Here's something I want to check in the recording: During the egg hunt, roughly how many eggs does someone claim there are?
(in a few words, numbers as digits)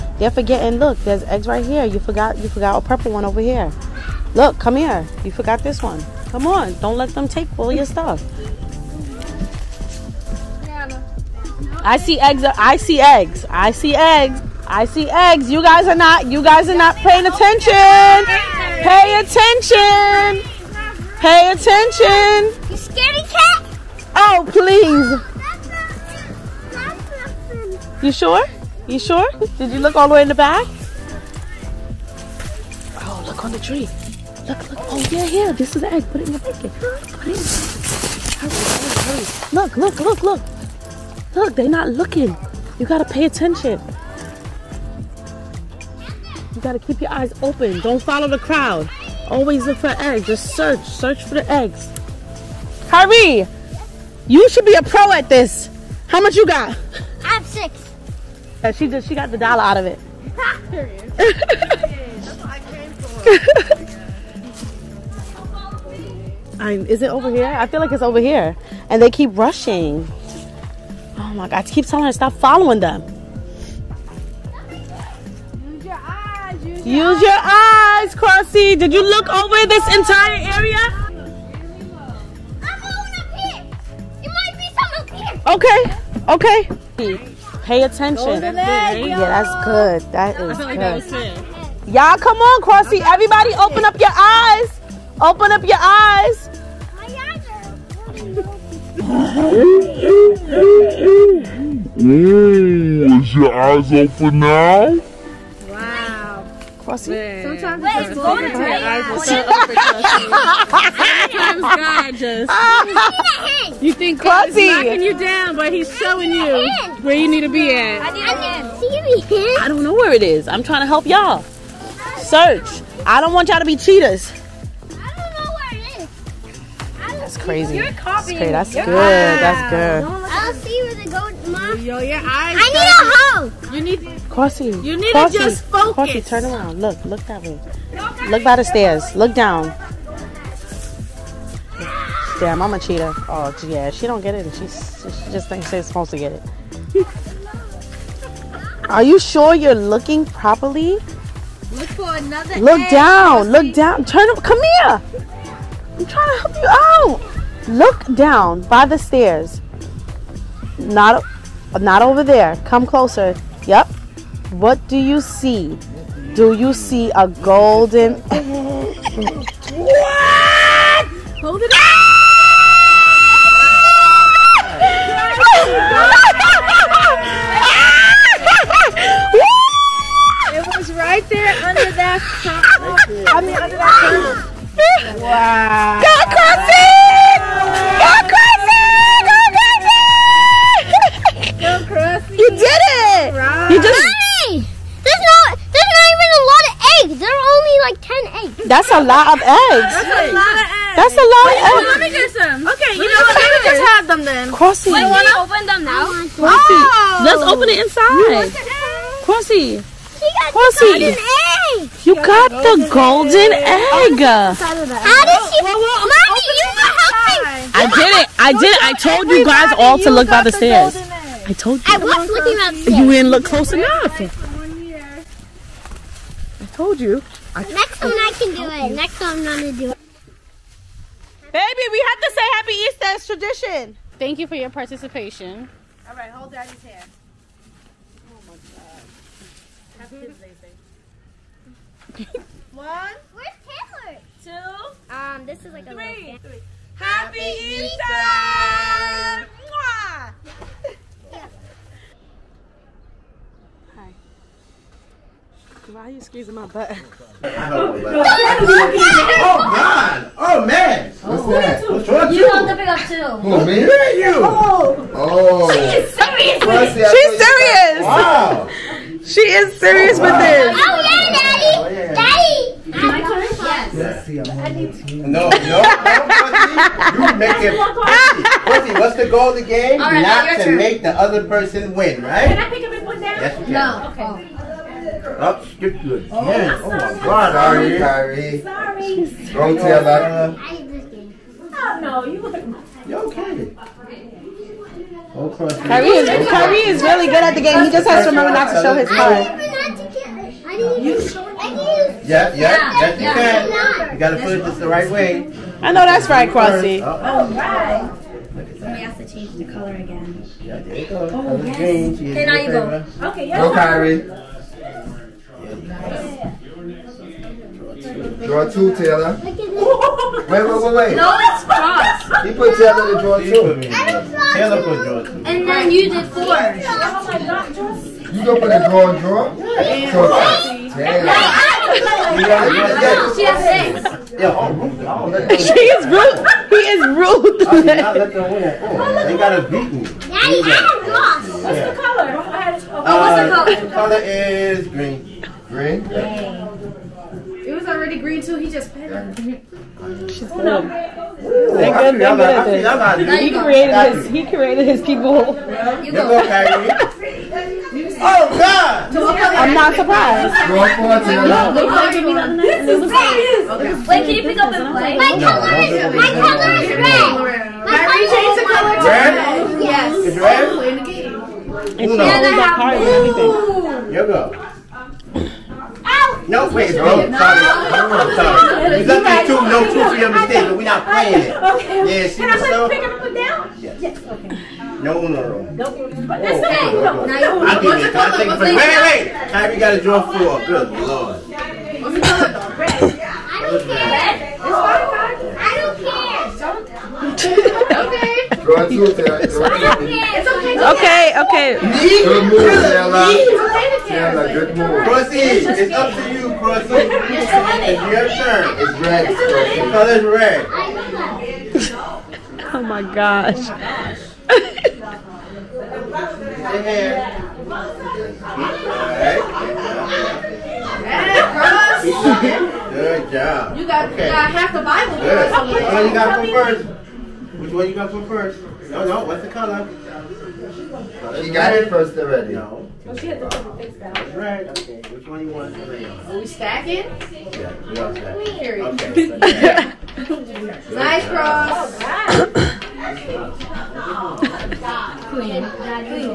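10.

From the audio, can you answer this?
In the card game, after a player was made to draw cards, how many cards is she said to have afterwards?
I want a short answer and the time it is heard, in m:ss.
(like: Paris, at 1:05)
6, at 5:33.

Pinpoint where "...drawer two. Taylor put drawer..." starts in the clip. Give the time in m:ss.
5:23.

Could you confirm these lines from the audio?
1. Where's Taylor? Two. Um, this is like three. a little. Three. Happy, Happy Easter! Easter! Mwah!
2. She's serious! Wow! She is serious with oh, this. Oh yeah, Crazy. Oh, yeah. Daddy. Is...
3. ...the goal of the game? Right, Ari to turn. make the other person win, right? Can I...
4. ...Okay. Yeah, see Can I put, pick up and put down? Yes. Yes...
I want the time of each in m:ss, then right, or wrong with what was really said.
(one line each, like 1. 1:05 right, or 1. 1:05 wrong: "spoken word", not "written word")
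1. 4:02 right
2. 4:27 wrong: "Daddy", not "Crazy"
3. 4:39 wrong: "Not", not "Ari"
4. 6:21 right.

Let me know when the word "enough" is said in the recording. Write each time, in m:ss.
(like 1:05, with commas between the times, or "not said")
3:43.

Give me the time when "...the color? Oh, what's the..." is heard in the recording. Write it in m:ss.
5:41.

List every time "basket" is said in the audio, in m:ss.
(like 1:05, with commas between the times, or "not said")
0:36.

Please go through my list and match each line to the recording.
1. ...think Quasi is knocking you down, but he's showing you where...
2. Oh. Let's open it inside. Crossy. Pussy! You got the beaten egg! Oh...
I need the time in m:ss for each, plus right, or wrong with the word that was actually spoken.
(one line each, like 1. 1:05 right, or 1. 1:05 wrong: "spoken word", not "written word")
1. 1:53 right
2. 3:26 wrong: "golden", not "beaten".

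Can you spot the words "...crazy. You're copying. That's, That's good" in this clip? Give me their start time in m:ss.
2:07.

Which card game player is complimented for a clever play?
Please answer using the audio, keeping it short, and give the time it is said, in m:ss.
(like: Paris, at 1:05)
Stella, at 6:42.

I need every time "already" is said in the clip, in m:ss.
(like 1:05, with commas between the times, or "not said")
5:47, 7:12.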